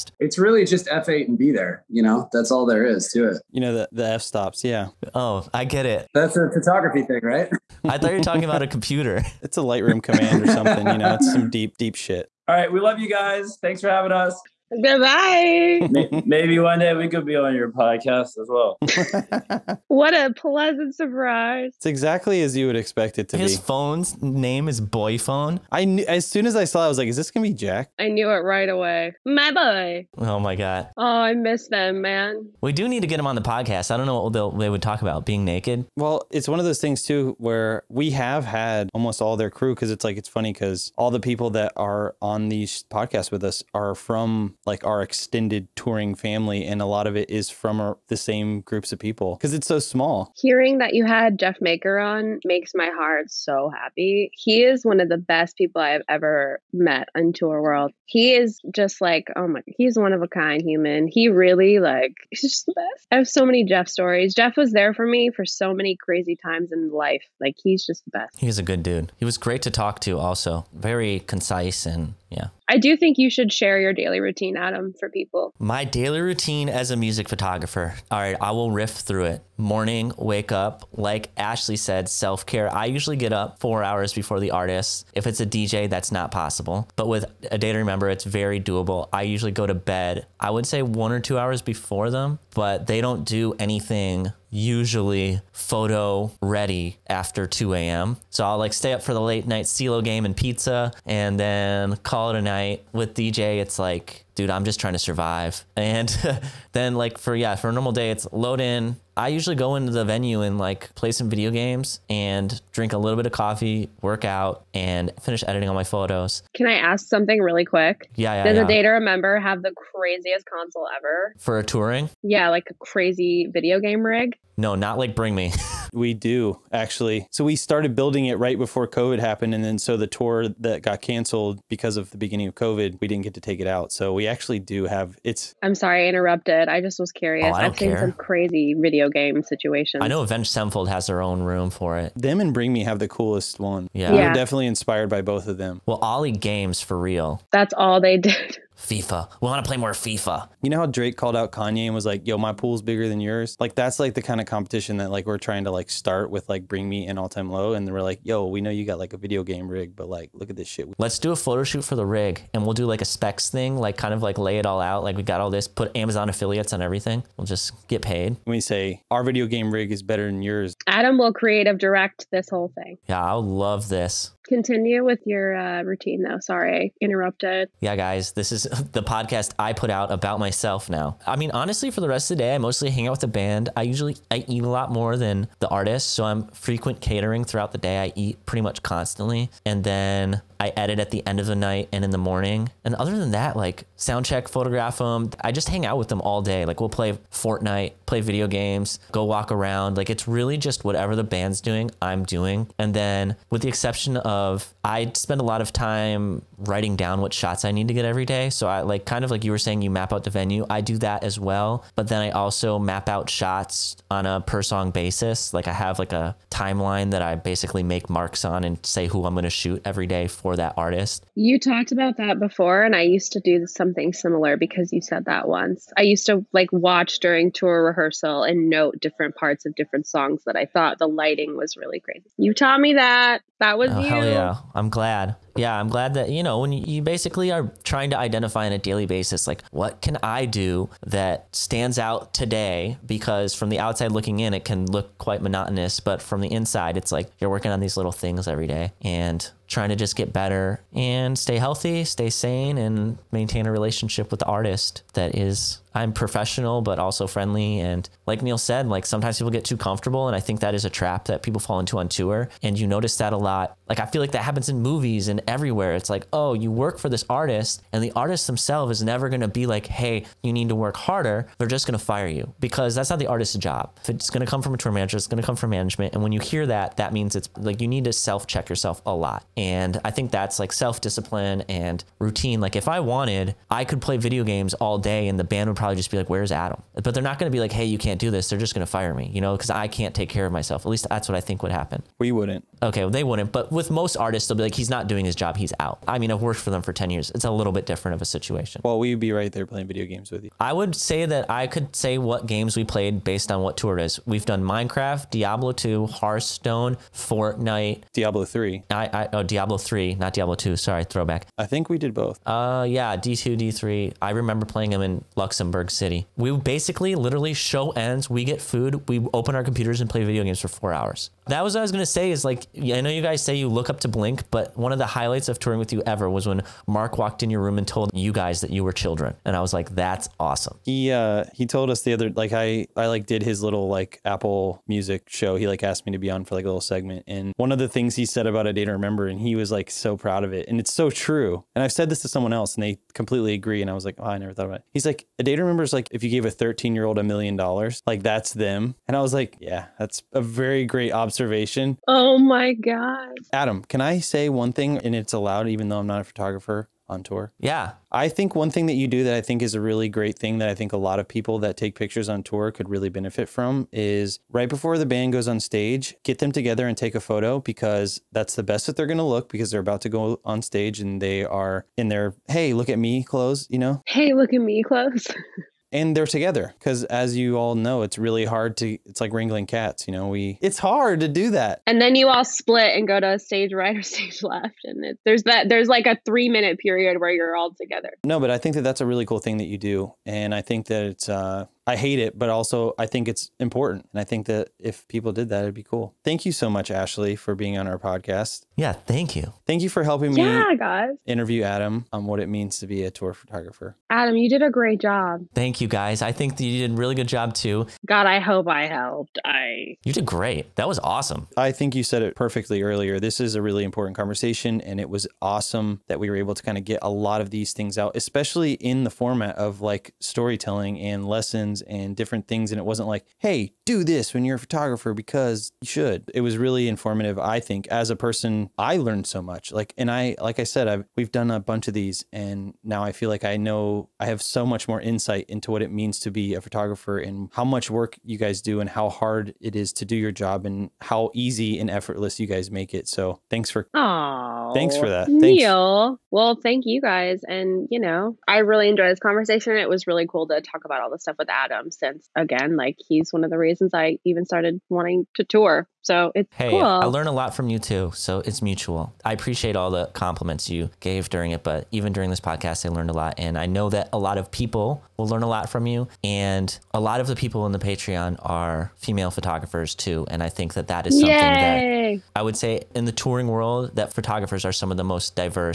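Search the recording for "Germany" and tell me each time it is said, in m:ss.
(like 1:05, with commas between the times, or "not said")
not said.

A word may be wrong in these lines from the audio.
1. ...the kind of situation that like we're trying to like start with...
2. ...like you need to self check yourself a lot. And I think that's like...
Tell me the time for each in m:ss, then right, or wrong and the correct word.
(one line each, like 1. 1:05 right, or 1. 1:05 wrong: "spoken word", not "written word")
1. 2:34 wrong: "competition", not "situation"
2. 4:37 right.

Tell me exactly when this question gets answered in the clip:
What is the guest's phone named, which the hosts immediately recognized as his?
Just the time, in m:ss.
0:24.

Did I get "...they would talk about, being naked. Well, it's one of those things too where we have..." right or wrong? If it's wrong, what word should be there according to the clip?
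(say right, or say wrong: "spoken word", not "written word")
right.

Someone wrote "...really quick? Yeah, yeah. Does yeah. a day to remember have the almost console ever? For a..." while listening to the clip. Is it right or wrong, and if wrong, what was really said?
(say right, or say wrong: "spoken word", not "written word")
wrong: "craziest", not "almost".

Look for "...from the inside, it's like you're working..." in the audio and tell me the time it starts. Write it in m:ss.
4:06.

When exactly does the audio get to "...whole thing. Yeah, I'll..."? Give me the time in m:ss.
2:52.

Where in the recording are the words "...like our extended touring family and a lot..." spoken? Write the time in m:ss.
0:44.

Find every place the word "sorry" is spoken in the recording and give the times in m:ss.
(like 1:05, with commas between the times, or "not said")
2:15, 2:56, 5:10.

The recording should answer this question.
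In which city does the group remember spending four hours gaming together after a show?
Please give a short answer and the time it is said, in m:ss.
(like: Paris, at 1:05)
Luxembourg City, at 5:15.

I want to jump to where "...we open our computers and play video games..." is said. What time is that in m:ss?
5:19.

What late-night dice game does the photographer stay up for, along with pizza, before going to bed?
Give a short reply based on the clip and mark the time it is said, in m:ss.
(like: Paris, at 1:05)
CeeLo, at 1:39.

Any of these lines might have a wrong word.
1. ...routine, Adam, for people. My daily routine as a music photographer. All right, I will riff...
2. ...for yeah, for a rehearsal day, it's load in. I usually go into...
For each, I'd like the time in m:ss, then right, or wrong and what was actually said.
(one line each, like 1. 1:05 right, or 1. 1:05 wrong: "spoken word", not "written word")
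1. 1:14 right
2. 1:47 wrong: "normal", not "rehearsal".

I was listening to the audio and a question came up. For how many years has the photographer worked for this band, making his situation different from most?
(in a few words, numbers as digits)
10.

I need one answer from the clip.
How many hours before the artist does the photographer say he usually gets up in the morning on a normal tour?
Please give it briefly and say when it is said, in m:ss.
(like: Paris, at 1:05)
4, at 1:23.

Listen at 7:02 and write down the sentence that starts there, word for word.
And it wasn't like, hey, do this when you're a photographer because you should.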